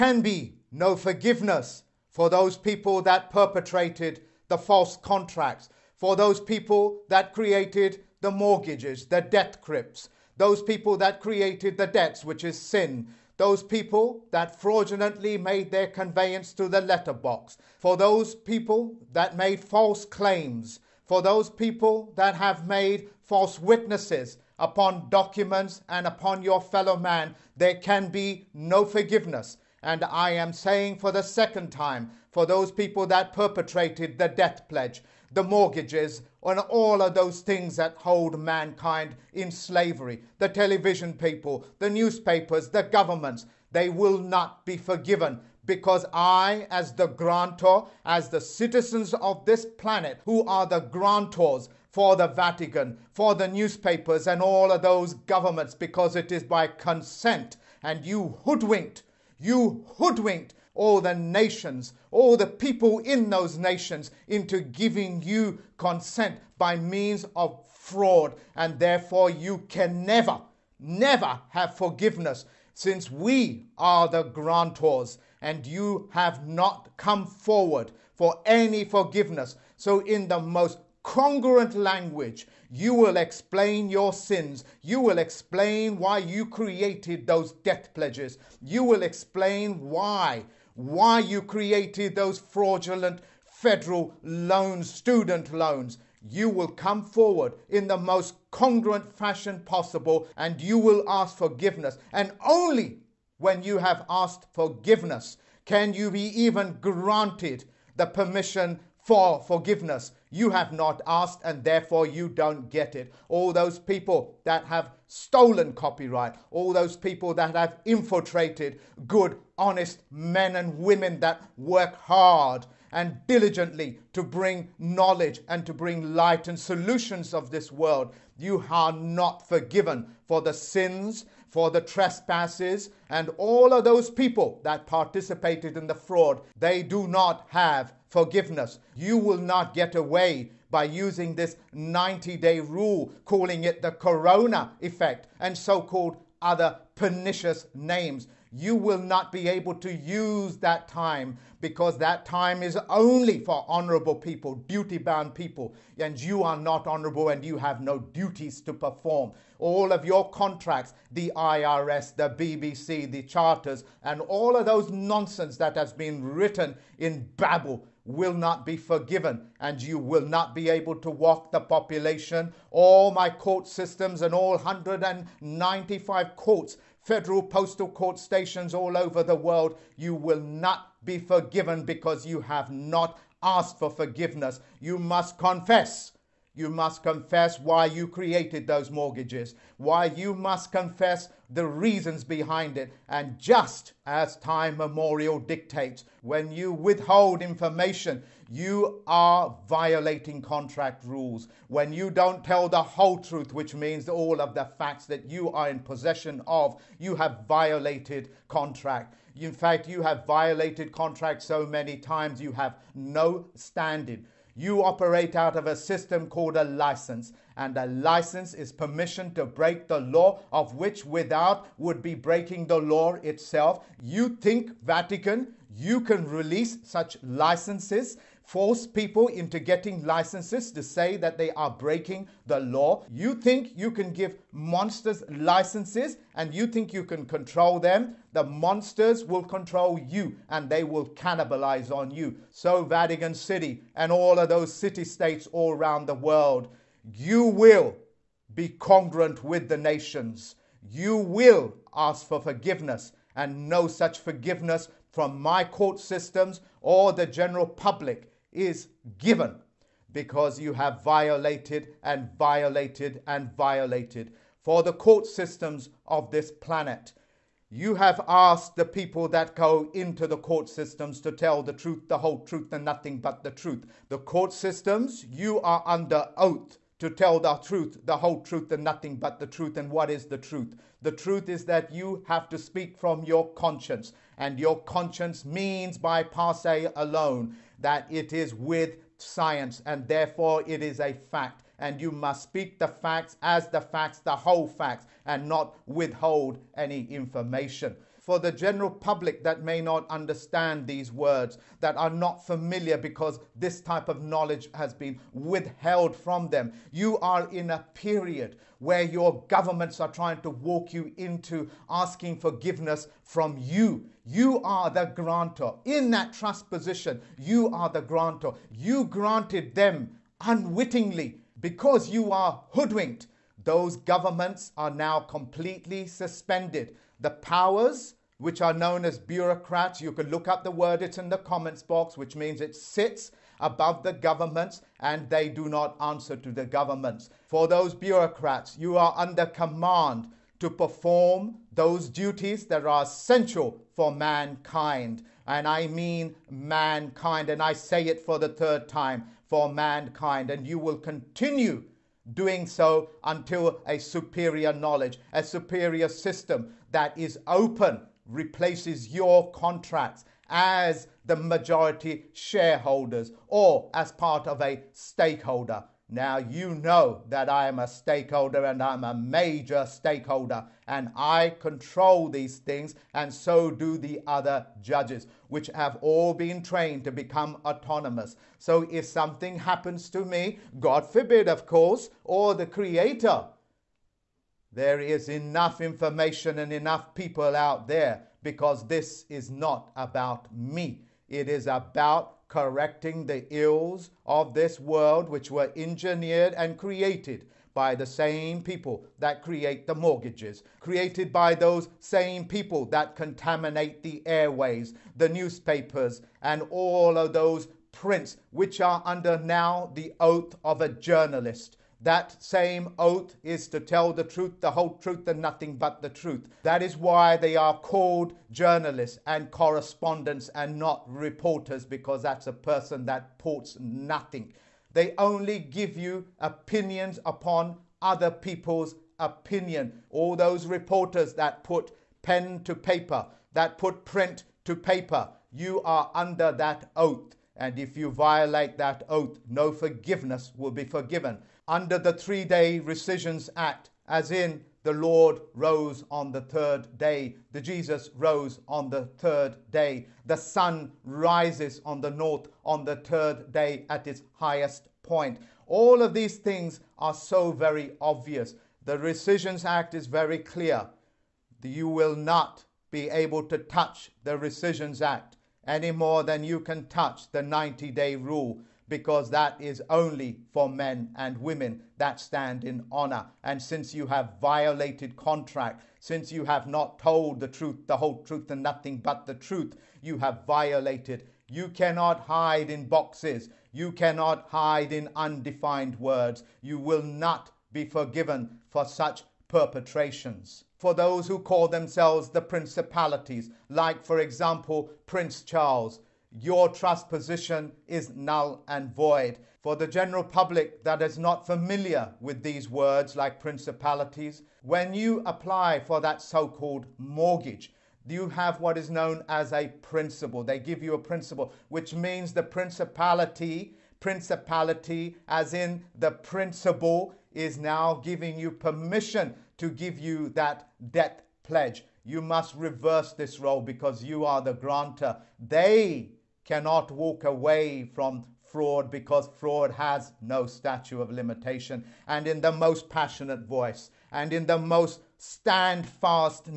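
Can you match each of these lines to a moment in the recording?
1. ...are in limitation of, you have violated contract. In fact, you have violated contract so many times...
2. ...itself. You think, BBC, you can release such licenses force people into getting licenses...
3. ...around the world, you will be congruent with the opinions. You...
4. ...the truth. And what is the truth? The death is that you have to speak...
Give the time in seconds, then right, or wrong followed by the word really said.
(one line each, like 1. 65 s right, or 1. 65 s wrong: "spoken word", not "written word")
1. 205 s wrong: "possession", not "limitation"
2. 223 s wrong: "Vatican", not "BBC"
3. 245 s wrong: "nations", not "opinions"
4. 279 s wrong: "truth", not "death".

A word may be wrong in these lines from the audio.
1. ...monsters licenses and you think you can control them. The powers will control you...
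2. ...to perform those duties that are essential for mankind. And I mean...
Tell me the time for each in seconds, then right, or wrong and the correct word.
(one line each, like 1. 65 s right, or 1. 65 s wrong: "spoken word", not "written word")
1. 234 s wrong: "monsters", not "powers"
2. 340 s right.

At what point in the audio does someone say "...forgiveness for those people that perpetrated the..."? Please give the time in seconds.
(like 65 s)
0 s.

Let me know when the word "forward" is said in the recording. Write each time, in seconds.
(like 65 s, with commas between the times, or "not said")
77 s, 97 s.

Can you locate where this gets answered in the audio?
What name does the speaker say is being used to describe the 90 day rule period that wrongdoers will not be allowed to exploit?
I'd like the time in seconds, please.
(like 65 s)
143 s.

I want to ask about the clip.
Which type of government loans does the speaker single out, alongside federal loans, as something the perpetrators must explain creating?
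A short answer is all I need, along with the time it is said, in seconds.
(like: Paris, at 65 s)
Student loans, at 94 s.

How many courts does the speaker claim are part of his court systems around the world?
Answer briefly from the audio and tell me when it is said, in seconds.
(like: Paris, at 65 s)
195, at 174 s.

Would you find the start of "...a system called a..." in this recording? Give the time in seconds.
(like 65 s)
215 s.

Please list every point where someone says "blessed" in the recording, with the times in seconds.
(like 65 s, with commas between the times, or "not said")
not said.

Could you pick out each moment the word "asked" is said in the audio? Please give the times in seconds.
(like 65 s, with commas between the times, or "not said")
104 s, 111 s, 183 s, 268 s.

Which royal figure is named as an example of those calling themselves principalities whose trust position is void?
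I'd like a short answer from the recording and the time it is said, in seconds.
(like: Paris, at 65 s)
Prince Charles, at 495 s.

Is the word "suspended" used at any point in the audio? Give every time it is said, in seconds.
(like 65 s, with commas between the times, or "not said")
326 s.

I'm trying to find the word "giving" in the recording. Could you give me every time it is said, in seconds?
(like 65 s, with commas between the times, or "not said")
64 s, 517 s.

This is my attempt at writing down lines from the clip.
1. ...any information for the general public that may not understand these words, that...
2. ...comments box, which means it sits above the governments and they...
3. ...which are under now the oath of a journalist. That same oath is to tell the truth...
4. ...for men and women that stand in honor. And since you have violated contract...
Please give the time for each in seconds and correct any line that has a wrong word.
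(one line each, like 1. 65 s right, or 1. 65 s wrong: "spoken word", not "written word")
1. 296 s right
2. 331 s right
3. 408 s right
4. 470 s right.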